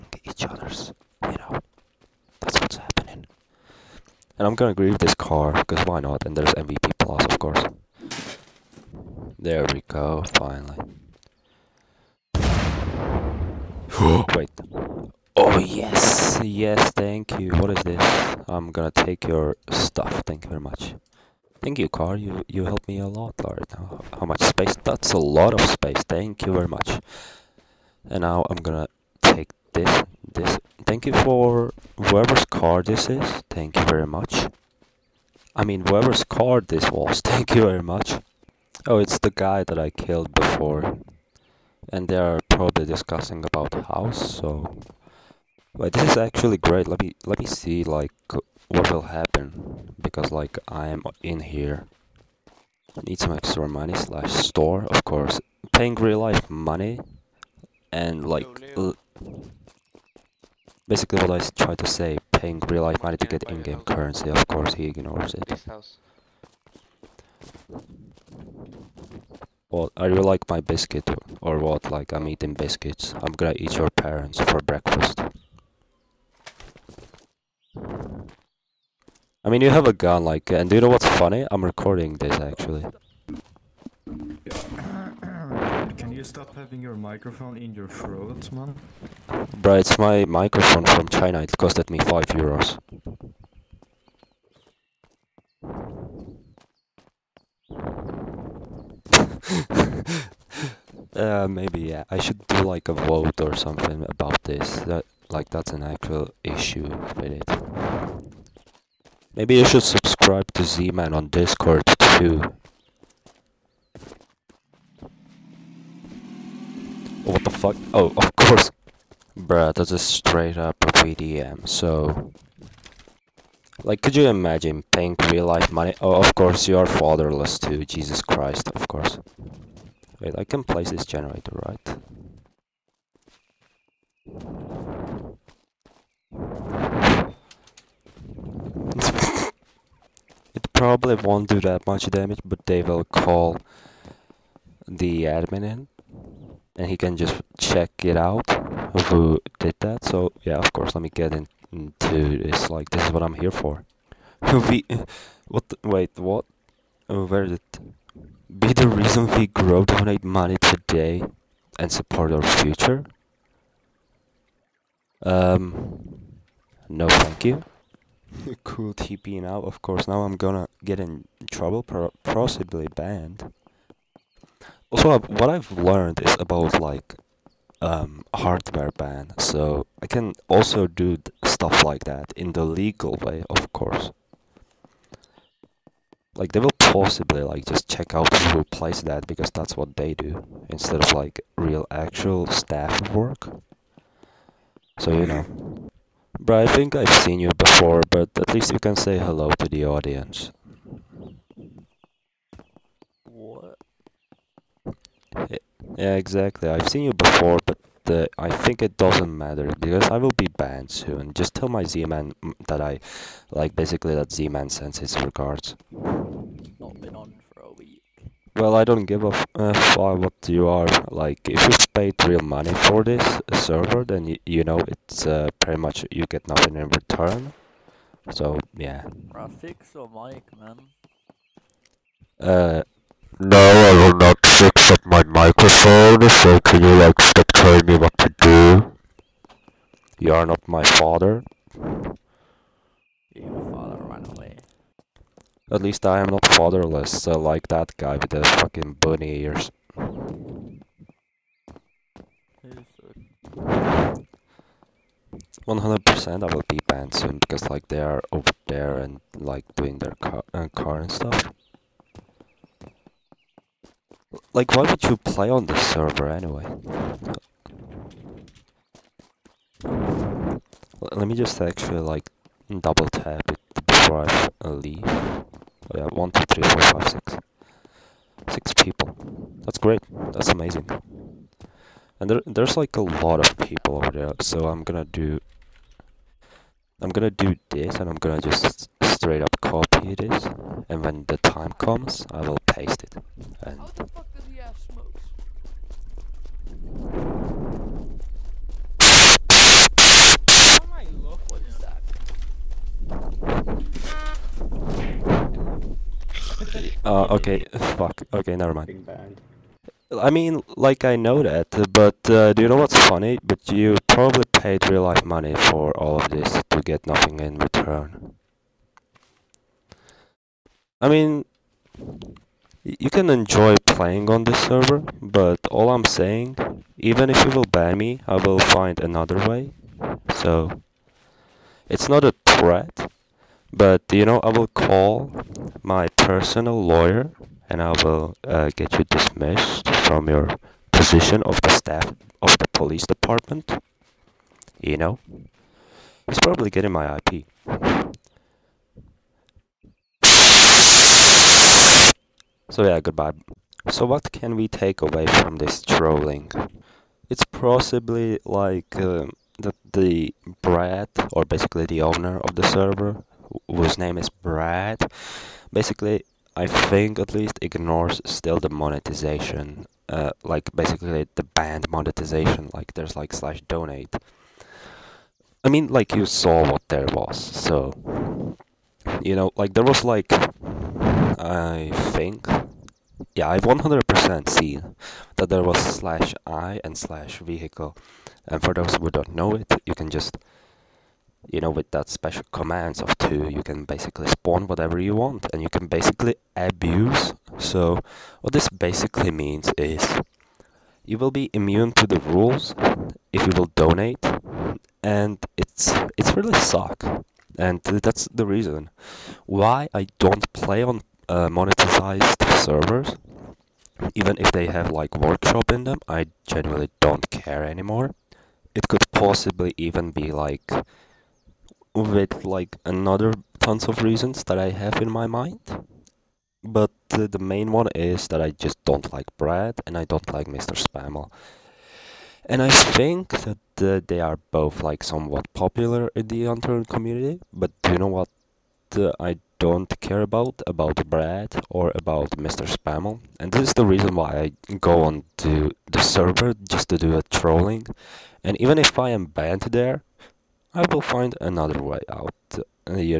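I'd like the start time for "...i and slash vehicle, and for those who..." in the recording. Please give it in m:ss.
6:26.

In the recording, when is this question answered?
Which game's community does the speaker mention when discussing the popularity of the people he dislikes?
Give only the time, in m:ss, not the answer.
7:16.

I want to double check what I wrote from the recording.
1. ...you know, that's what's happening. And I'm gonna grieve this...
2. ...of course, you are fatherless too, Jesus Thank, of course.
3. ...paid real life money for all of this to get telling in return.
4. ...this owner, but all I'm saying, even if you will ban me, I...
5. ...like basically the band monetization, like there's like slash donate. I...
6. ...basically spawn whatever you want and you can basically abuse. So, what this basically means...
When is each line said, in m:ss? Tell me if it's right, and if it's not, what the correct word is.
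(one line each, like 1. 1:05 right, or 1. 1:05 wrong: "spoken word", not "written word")
1. 0:01 right
2. 2:06 wrong: "Christ", not "Thank"
3. 5:14 wrong: "nothing", not "telling"
4. 5:24 wrong: "server", not "owner"
5. 6:10 right
6. 6:33 right.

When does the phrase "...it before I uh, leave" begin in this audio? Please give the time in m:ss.
4:33.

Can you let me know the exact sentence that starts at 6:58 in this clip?
It could possibly even be like with like another tons of reasons that I have in my mind.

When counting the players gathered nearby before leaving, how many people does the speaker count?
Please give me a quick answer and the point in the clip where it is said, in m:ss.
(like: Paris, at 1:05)
6, at 4:38.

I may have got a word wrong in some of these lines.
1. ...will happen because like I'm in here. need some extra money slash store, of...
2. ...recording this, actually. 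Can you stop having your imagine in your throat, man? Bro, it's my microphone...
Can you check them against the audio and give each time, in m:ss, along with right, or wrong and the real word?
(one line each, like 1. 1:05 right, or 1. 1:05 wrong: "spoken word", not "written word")
1. 0:48 right
2. 1:21 wrong: "microphone", not "imagine".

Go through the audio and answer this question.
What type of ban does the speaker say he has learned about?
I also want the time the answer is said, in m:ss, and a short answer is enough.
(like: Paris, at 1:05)
Hardware ban, at 2:58.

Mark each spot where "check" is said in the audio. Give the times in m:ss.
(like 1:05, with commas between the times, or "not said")
2:27, 3:07.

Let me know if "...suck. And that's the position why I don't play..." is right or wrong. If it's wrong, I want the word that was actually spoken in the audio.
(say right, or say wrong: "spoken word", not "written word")
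wrong: "reason", not "position".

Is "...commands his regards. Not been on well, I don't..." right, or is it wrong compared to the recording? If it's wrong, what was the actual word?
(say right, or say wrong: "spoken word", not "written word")
wrong: "sends", not "commands".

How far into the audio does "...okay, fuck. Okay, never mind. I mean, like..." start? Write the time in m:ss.
5:07.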